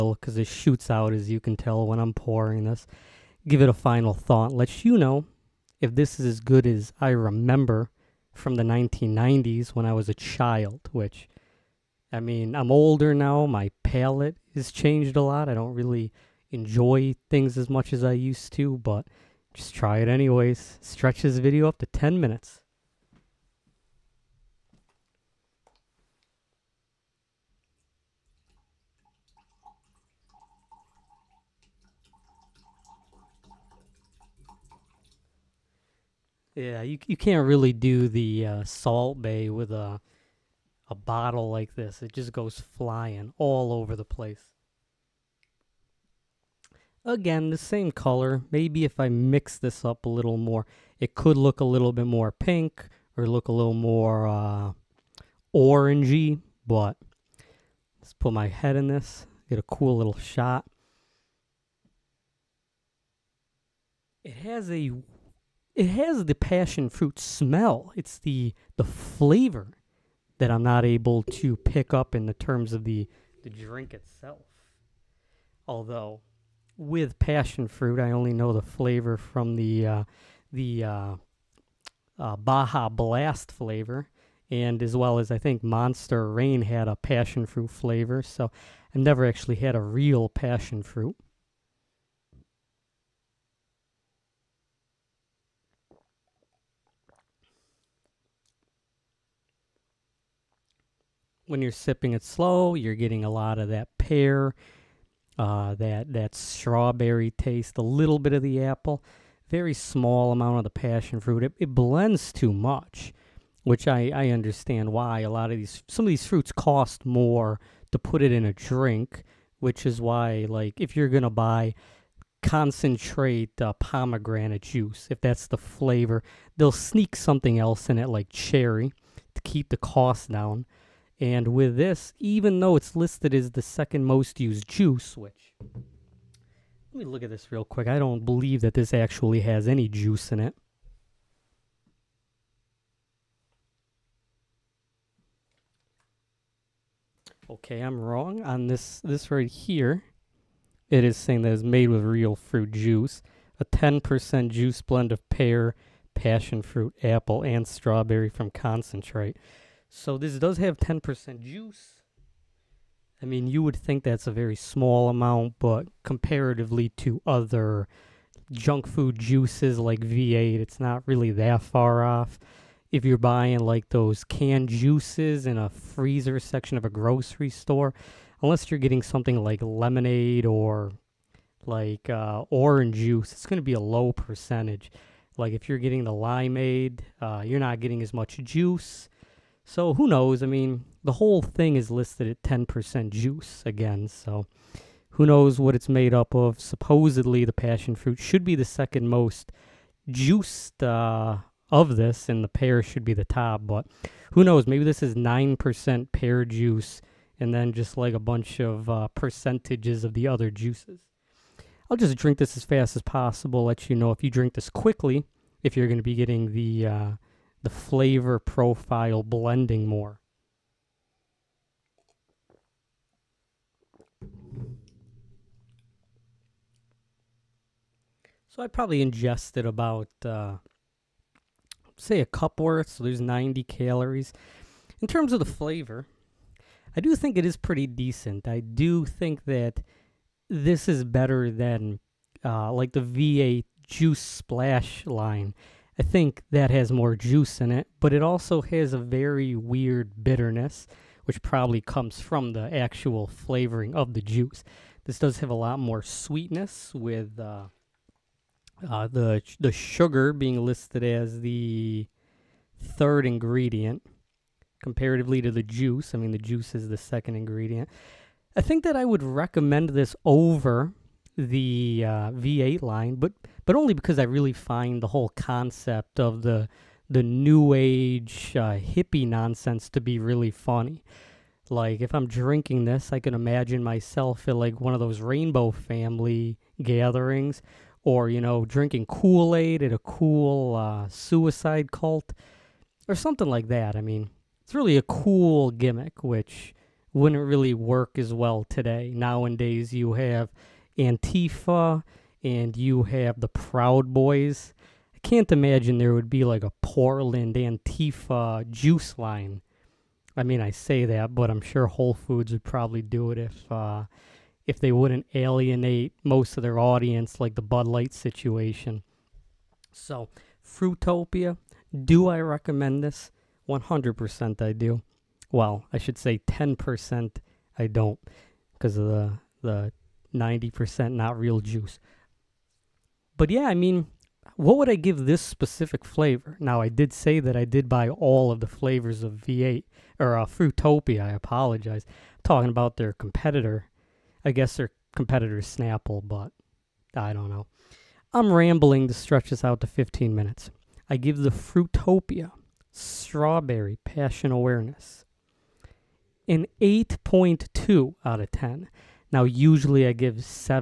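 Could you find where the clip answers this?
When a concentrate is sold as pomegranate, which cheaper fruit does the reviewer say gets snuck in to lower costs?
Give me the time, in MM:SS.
02:08.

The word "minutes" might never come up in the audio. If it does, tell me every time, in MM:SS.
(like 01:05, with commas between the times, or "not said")
00:22, 05:50.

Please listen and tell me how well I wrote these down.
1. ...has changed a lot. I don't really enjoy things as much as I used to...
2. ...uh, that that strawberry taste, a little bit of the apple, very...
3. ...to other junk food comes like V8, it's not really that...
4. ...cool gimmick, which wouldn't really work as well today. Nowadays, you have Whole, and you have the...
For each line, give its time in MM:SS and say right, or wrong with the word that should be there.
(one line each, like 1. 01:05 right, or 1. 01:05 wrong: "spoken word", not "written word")
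1. 00:14 right
2. 01:45 right
3. 02:46 wrong: "juices", not "comes"
4. 04:55 wrong: "Antifa", not "Whole".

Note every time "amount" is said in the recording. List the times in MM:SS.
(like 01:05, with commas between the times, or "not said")
01:50, 02:45.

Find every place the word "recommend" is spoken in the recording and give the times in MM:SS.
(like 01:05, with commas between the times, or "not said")
04:29, 05:22.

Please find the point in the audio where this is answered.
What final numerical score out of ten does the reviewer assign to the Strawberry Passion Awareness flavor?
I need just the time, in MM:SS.
05:56.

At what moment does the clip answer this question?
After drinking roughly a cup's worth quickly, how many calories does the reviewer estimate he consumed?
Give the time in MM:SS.
03:53.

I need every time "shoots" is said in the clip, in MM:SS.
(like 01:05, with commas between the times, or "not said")
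00:00.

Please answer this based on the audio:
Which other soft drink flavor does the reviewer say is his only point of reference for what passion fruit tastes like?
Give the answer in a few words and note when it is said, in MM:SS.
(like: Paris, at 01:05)
Baja Blast, at 01:22.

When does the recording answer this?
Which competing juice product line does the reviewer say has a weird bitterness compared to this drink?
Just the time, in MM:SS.
04:02.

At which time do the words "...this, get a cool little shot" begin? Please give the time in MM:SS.
00:58.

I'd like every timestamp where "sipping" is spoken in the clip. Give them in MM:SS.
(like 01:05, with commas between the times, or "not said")
01:41.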